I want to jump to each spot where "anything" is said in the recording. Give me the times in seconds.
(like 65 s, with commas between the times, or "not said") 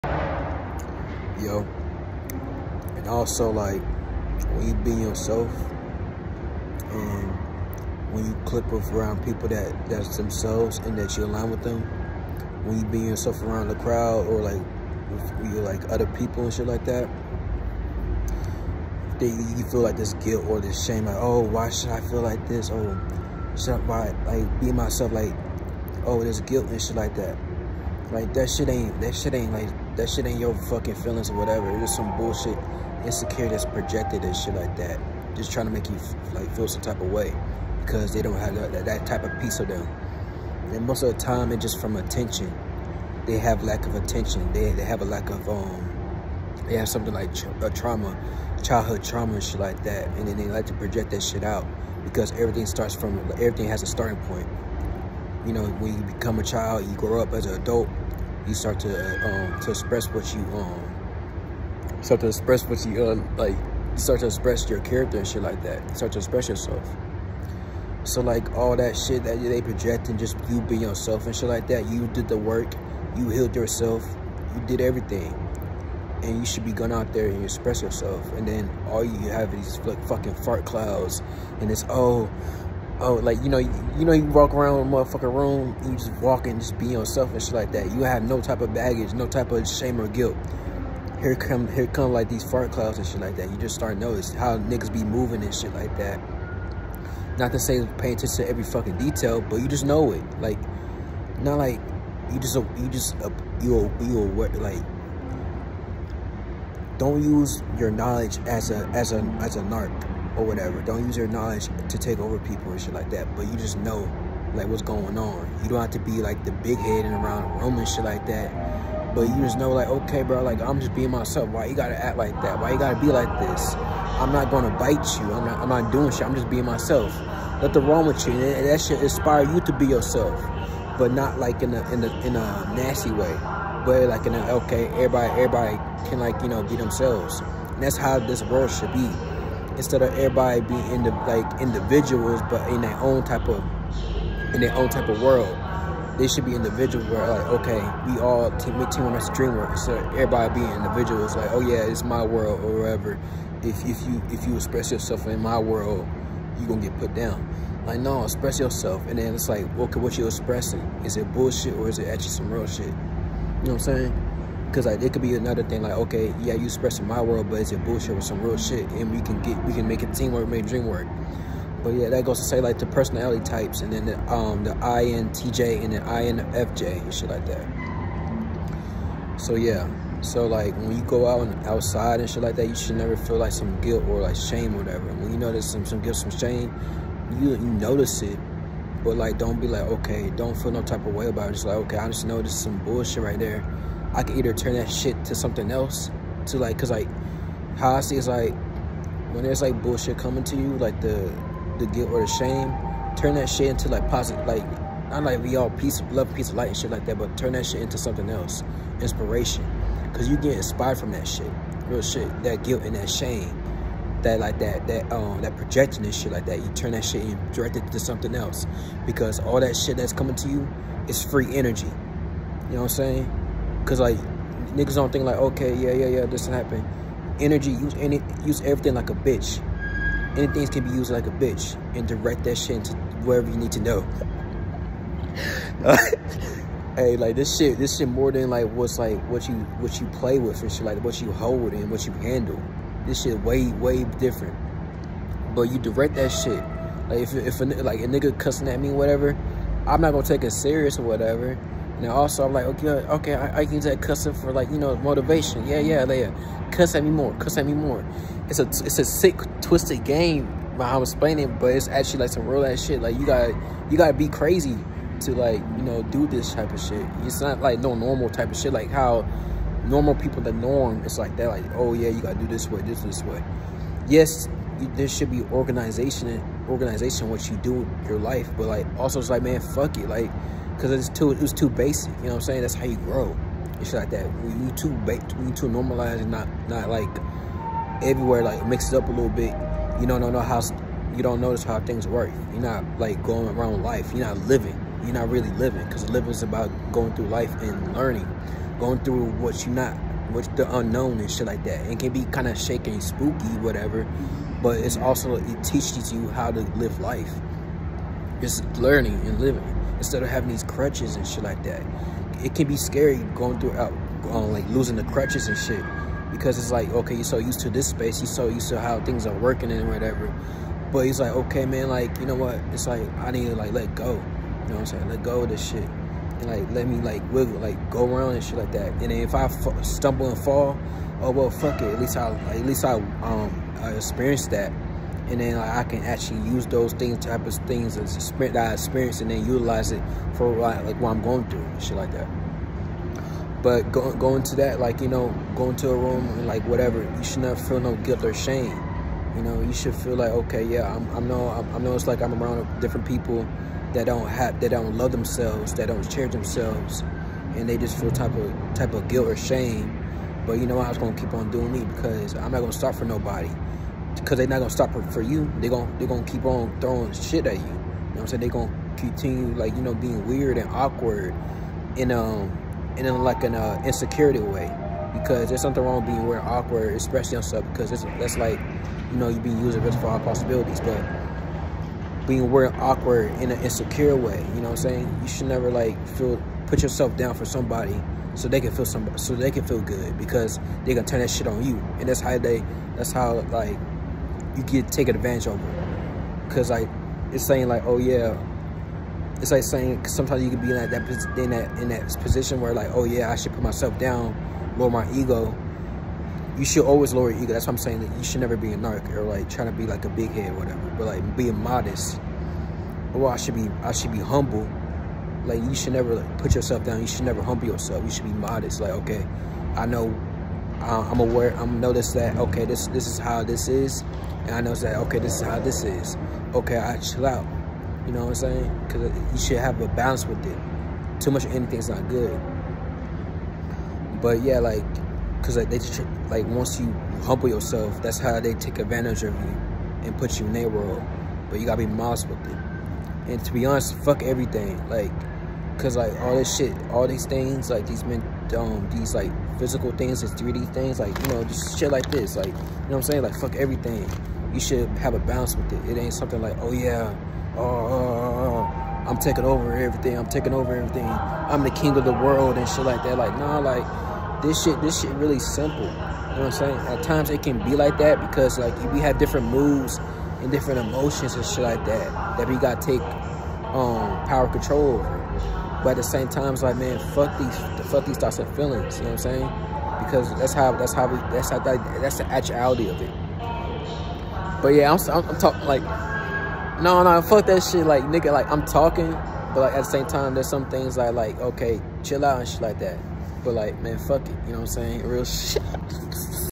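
230 s, 431 s.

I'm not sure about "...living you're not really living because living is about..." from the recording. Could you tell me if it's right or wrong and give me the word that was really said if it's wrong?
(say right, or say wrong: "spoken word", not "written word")
right.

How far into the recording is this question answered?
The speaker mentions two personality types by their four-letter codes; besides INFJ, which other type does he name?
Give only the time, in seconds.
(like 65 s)
174 s.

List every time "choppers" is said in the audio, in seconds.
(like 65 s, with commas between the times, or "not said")
not said.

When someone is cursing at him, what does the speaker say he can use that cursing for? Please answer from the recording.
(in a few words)
motivation.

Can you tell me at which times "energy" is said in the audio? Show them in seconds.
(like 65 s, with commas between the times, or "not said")
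221 s, 227 s.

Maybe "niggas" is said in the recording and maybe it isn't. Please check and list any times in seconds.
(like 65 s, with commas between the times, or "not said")
94 s, 224 s, 248 s, 488 s.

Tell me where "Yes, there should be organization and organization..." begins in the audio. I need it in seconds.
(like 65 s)
274 s.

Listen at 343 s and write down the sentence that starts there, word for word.
But going to that, like you know, going to a room and like whatever, you should not feel no guilt or shame.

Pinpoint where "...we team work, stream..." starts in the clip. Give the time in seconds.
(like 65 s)
148 s.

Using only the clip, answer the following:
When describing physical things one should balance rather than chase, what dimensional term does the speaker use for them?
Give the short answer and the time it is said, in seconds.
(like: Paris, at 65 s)
3D things, at 450 s.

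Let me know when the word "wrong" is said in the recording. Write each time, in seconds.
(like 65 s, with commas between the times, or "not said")
127 s, 375 s.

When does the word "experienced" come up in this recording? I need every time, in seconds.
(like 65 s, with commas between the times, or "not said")
333 s, 338 s.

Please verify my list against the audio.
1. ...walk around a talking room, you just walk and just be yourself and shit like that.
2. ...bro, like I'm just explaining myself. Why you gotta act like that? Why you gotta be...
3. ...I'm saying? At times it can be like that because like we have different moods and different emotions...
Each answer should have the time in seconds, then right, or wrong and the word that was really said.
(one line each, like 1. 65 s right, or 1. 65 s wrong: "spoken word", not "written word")
1. 84 s wrong: "motherfucking", not "talking"
2. 120 s wrong: "being", not "explaining"
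3. 466 s right.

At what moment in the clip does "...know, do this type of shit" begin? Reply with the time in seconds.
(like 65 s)
265 s.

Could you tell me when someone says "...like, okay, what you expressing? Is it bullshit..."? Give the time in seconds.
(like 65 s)
159 s.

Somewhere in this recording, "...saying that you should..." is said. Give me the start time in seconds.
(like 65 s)
407 s.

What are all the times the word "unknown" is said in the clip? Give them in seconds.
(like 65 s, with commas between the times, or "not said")
300 s.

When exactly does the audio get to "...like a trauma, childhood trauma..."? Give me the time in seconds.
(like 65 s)
47 s.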